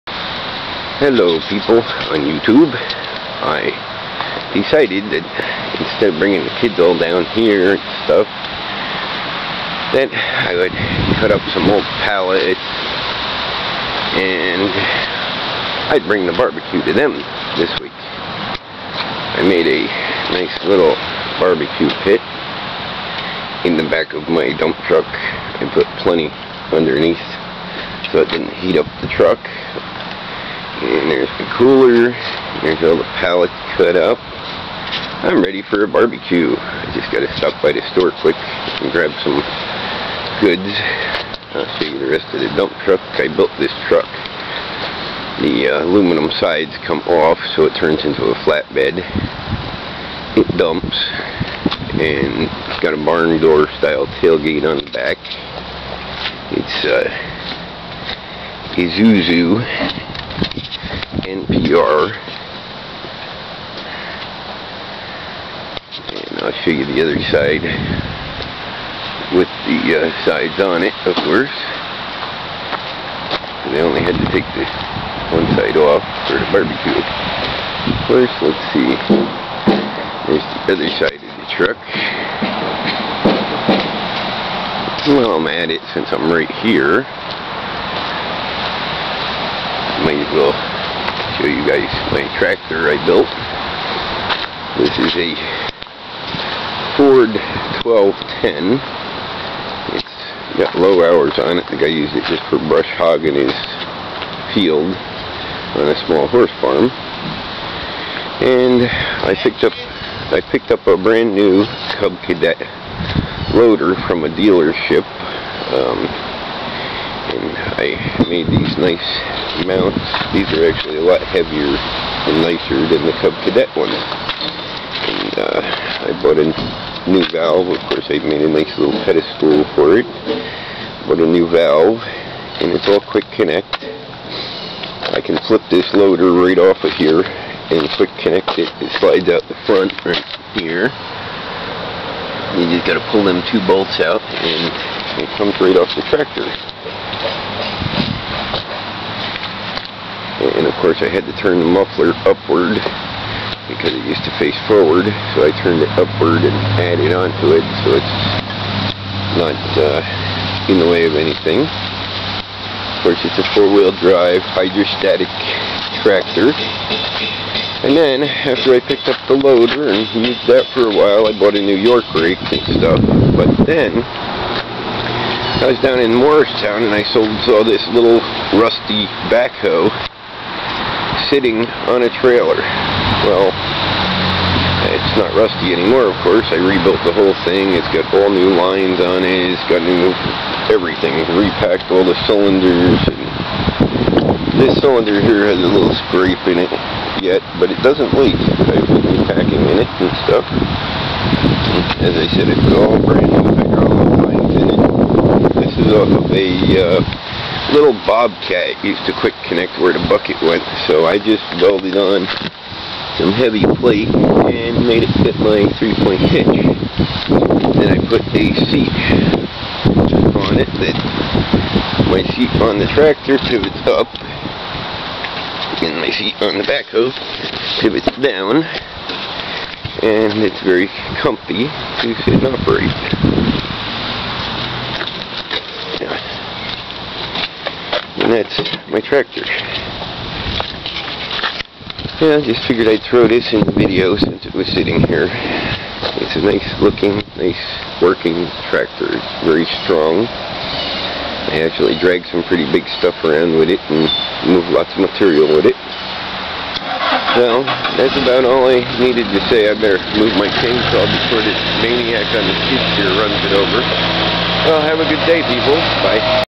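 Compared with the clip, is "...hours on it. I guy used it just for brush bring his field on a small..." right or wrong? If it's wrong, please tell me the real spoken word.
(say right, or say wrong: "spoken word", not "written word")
wrong: "hogging", not "bring".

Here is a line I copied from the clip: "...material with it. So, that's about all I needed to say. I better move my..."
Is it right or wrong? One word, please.
right.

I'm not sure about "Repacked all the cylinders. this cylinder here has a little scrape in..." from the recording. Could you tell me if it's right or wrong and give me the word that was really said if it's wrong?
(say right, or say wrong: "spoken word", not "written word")
right.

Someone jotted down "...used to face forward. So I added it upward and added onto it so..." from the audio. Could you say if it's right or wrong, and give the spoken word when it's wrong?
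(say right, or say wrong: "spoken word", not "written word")
wrong: "turned", not "added".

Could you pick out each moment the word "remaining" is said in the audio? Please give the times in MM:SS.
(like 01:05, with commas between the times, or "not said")
not said.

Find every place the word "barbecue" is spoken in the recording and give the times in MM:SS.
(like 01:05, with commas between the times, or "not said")
00:16, 00:21, 00:35, 01:16.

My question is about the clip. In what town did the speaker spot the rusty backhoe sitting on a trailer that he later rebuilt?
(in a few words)
Morristown.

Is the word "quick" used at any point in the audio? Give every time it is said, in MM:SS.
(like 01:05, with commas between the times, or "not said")
00:38, 02:13, 02:17, 03:29.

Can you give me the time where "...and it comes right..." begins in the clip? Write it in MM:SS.
02:24.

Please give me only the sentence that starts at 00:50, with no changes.
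It dumps and it's got a barn door style tailgate on the back.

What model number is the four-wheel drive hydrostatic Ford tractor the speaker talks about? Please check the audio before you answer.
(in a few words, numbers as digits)
1210.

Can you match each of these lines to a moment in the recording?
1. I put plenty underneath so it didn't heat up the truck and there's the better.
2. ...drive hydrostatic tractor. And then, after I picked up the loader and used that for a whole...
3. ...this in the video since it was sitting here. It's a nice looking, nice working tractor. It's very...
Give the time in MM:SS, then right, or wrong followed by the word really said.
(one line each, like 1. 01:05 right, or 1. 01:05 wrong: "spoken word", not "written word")
1. 00:25 wrong: "cooler", not "better"
2. 02:44 wrong: "while", not "whole"
3. 04:03 right.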